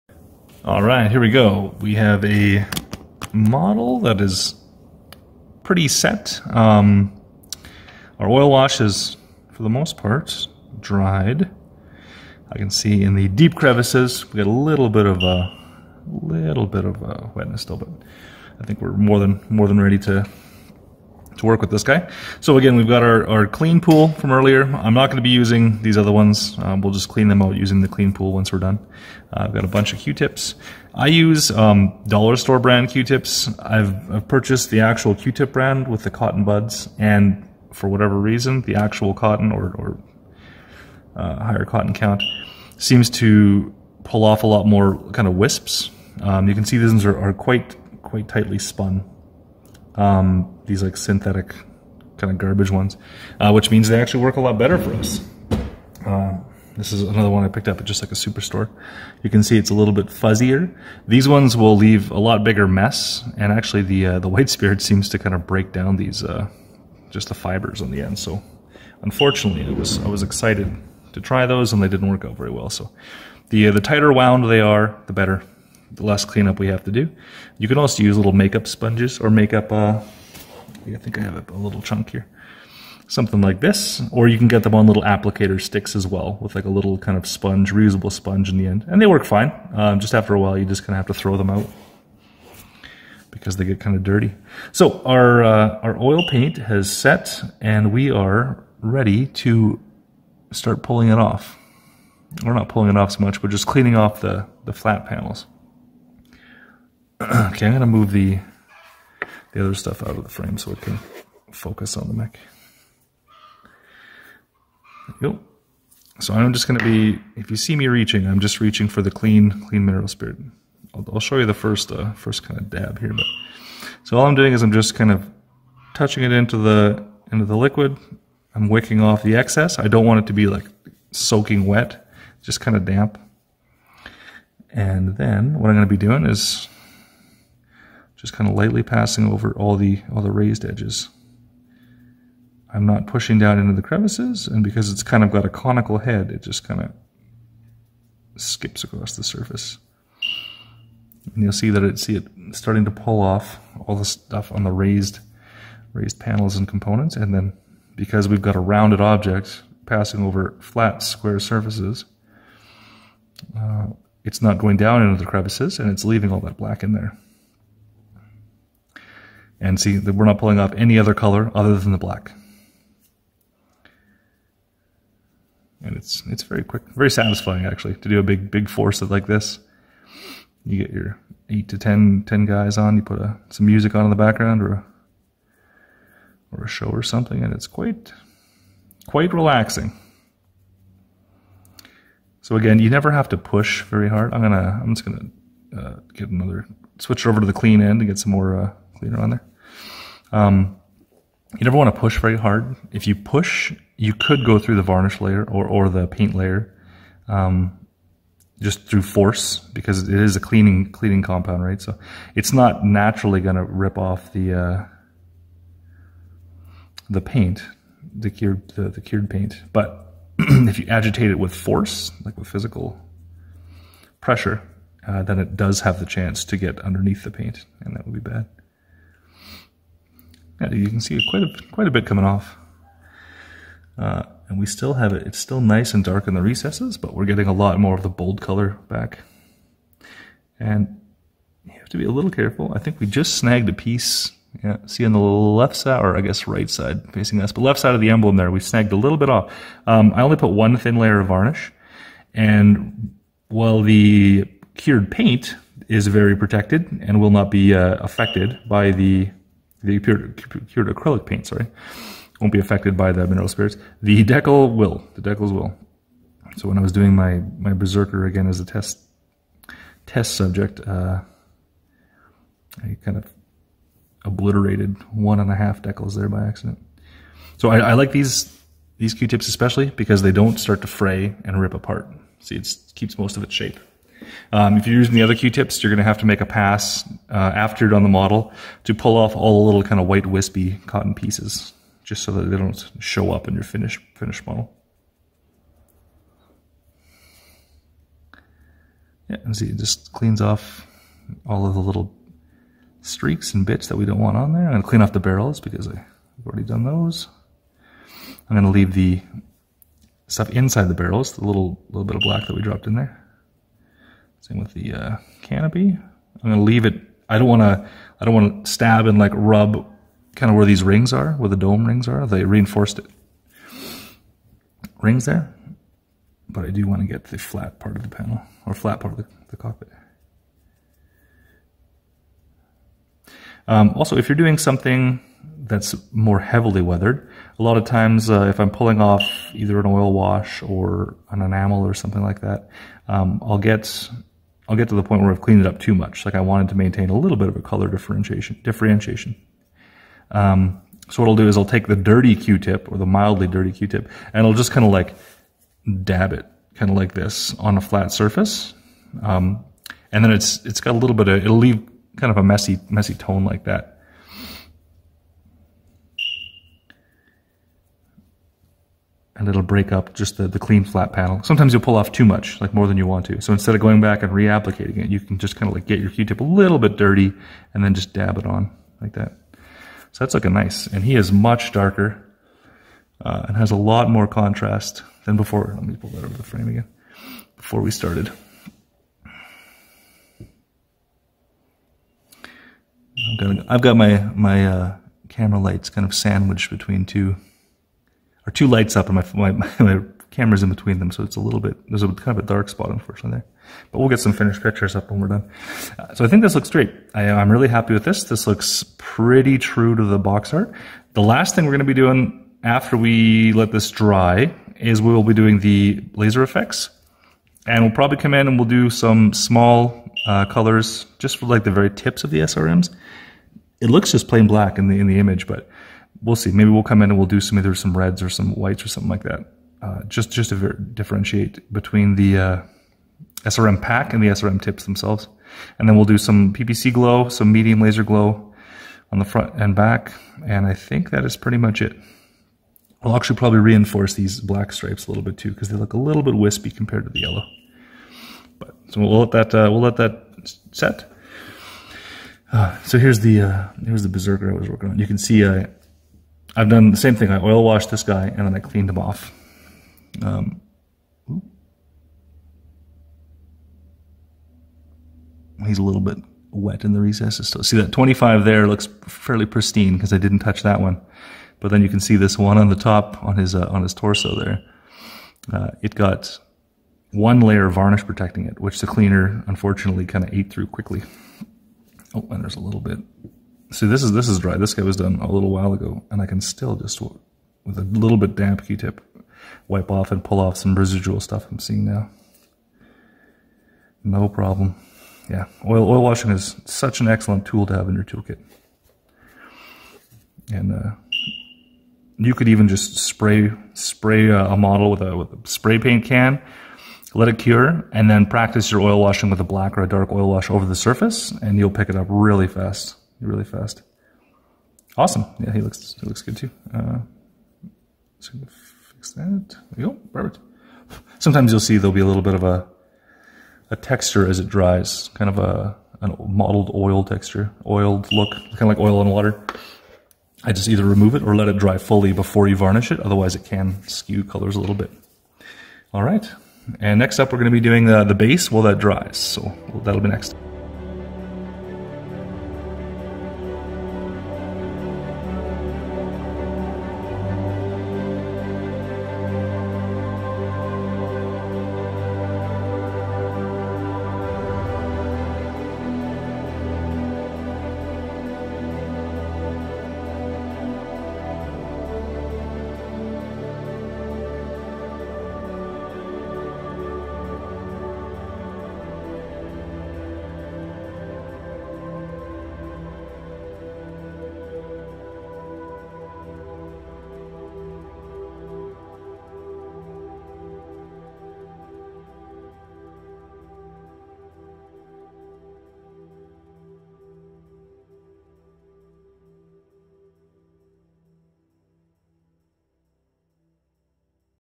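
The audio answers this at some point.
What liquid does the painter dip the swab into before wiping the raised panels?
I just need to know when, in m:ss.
1:59.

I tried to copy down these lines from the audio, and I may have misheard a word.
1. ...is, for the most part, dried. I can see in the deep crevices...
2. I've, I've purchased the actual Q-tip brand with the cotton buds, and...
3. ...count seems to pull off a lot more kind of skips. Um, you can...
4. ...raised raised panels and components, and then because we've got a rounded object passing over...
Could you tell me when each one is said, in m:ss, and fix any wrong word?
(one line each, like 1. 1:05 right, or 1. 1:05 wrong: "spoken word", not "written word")
1. 0:08 right
2. 0:33 right
3. 0:41 wrong: "wisps", not "skips"
4. 2:34 right.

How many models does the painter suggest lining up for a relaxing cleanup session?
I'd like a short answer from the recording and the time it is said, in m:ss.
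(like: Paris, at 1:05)
8 to 10, at 3:01.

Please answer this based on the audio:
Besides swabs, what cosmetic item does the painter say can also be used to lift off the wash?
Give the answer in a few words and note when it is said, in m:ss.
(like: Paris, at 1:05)
makeup sponges, at 1:18.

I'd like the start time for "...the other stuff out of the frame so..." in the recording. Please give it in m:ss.
1:49.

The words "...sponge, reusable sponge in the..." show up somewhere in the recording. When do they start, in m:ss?
1:27.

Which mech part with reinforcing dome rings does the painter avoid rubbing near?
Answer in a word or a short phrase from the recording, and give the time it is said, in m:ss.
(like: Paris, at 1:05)
canopy, at 5:15.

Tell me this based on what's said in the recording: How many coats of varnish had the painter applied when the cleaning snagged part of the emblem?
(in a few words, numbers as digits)
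1.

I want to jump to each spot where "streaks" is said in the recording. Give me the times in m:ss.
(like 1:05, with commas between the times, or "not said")
5:03.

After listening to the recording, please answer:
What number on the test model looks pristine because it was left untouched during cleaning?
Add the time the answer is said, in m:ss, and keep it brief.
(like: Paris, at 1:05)
25, at 7:47.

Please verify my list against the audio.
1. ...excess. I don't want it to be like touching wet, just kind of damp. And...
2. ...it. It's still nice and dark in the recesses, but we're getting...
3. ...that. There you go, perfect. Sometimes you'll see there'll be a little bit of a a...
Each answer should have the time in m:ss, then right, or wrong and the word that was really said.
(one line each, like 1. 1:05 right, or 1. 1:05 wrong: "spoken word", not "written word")
1. 2:09 wrong: "soaking", not "touching"
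2. 3:55 right
3. 8:39 right.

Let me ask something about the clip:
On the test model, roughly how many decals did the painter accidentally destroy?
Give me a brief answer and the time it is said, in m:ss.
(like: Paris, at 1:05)
1.5, at 4:35.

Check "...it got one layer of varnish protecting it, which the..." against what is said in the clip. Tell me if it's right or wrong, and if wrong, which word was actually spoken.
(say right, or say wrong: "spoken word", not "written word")
right.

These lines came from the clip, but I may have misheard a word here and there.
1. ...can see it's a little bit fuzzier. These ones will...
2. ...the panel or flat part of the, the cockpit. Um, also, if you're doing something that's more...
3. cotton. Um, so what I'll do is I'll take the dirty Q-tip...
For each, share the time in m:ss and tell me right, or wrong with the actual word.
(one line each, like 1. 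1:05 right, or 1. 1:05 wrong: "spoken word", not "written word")
1. 0:59 right
2. 5:28 right
3. 5:48 wrong: "differentiation", not "cotton".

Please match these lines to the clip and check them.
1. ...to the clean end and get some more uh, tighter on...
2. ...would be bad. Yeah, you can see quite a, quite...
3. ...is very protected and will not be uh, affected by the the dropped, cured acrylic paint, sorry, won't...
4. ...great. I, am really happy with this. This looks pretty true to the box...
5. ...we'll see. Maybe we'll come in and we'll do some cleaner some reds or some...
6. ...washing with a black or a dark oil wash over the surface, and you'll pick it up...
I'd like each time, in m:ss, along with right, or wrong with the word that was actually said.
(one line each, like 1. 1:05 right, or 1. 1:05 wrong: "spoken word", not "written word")
1. 3:17 wrong: "cleaner", not "tighter"
2. 3:48 right
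3. 4:15 wrong: "cured", not "dropped"
4. 6:46 right
5. 7:06 wrong: "either", not "cleaner"
6. 8:29 right.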